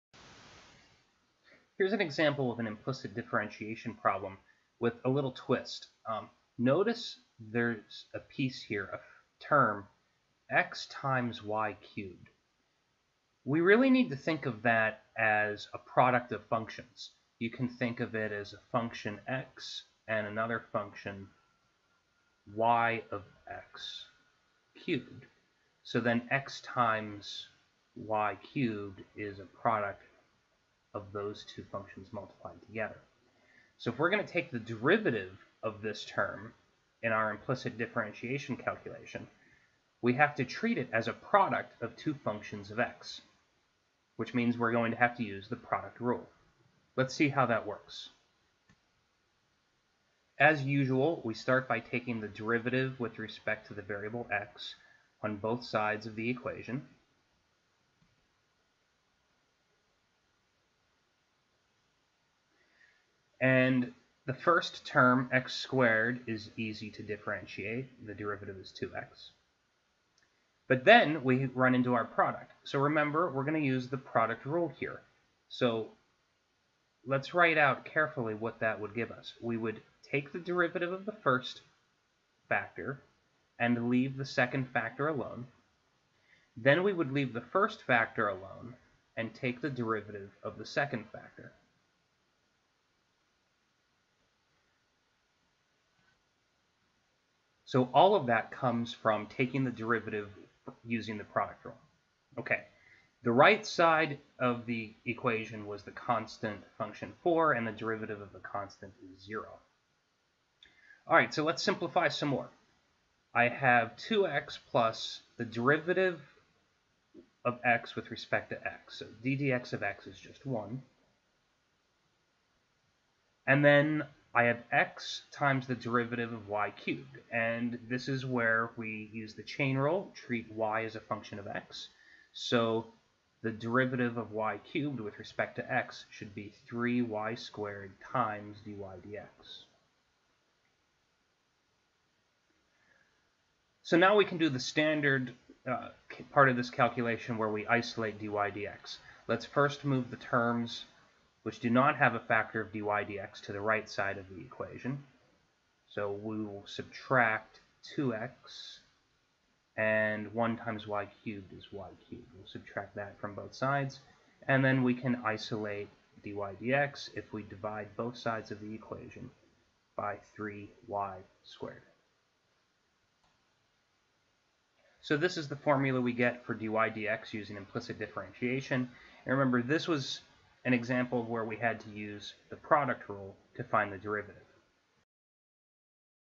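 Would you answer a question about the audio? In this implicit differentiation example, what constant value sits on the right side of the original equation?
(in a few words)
4.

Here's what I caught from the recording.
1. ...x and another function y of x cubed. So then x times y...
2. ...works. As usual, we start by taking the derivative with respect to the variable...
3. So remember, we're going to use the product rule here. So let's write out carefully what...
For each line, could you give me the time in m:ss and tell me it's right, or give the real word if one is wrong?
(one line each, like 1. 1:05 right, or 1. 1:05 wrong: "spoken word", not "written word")
1. 0:19 right
2. 0:47 right
3. 1:12 right.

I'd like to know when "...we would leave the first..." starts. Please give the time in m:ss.
1:26.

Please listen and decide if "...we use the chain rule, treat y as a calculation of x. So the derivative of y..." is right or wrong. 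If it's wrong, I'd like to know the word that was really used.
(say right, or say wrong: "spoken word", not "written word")
wrong: "function", not "calculation".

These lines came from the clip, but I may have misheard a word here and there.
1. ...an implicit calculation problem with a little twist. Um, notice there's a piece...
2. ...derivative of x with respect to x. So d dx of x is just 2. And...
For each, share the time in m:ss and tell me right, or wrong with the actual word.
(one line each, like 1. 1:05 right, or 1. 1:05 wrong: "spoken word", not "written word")
1. 0:02 wrong: "differentiation", not "calculation"
2. 1:55 wrong: "1", not "2".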